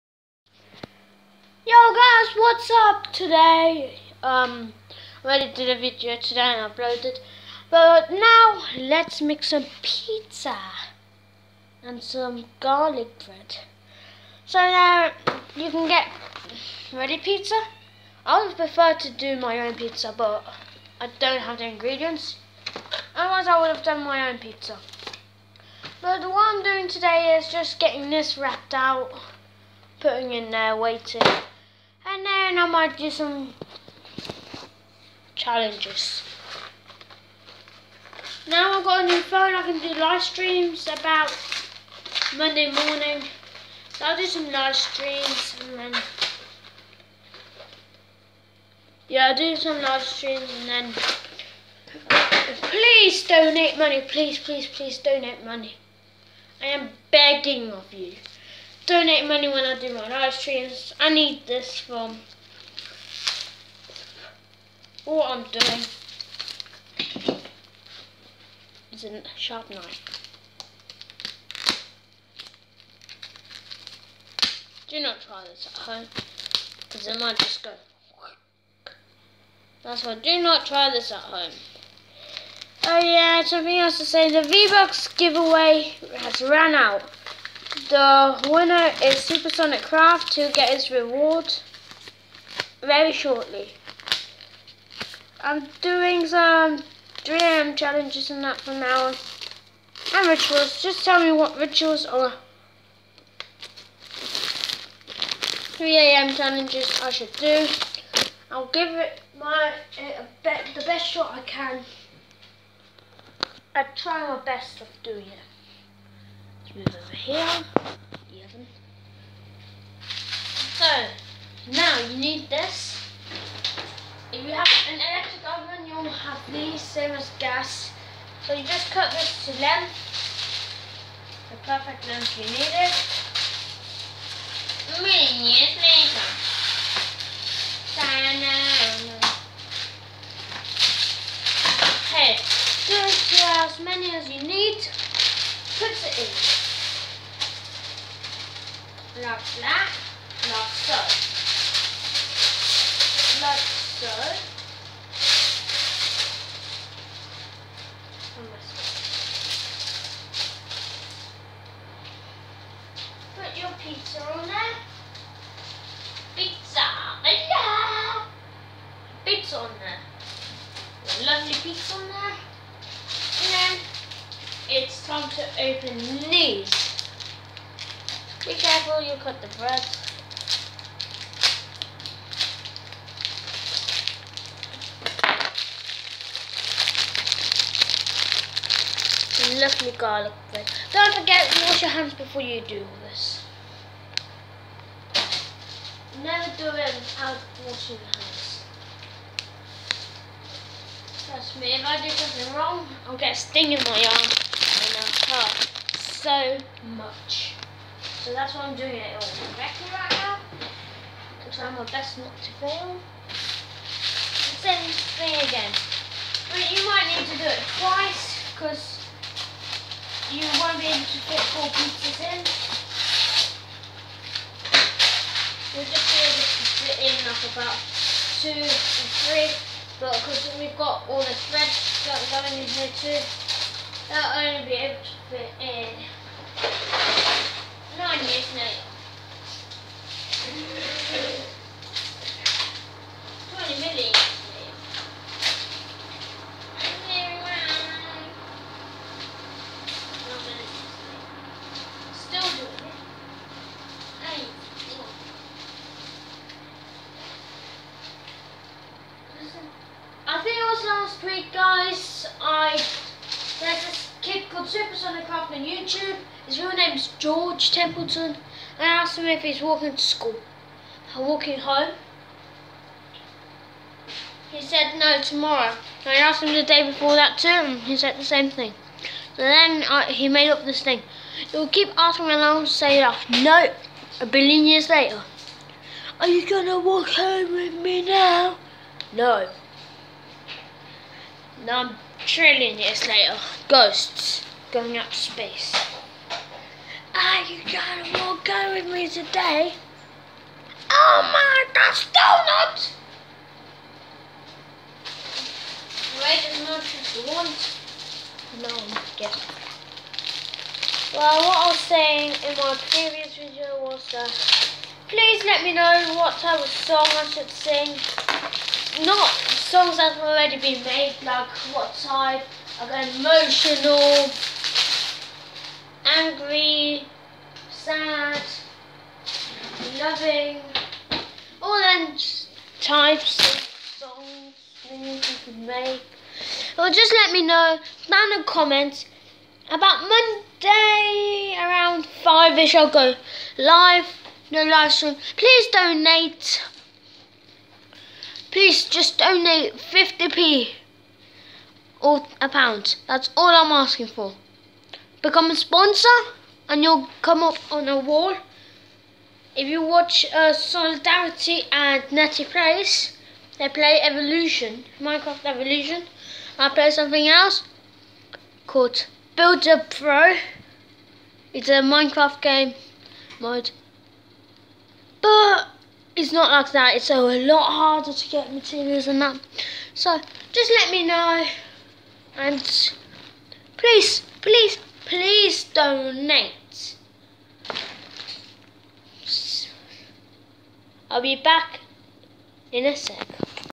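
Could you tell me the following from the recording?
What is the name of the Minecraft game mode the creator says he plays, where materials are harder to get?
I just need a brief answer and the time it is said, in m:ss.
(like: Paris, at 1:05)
Builder Pro, at 6:09.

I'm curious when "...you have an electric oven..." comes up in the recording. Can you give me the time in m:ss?
2:04.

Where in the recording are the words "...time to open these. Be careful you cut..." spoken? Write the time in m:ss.
2:55.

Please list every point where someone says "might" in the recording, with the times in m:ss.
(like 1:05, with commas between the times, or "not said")
0:32, 1:17, 3:36.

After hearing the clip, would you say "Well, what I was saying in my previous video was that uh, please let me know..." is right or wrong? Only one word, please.
right.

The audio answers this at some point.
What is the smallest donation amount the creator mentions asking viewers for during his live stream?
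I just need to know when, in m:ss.
5:49.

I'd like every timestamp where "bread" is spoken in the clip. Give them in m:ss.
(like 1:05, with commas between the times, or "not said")
0:13, 2:59, 3:10.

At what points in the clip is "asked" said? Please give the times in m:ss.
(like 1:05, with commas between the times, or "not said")
4:28, 4:36.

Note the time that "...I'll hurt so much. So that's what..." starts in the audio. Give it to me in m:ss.
3:24.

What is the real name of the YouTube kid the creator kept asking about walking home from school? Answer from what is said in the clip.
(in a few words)
George Templeton.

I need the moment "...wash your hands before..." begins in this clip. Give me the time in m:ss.
3:11.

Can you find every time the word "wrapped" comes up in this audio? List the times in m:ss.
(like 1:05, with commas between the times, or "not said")
0:28.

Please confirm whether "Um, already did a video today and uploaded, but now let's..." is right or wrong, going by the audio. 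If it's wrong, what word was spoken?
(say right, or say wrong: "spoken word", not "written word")
right.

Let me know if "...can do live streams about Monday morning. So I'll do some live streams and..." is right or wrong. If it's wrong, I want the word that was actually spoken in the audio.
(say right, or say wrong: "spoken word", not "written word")
right.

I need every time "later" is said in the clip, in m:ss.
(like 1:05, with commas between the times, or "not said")
2:15, 4:44, 4:53.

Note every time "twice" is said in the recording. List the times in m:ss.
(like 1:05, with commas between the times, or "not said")
3:37.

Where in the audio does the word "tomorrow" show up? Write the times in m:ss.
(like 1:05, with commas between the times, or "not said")
4:35.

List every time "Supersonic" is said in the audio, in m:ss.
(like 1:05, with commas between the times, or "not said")
1:29, 4:24.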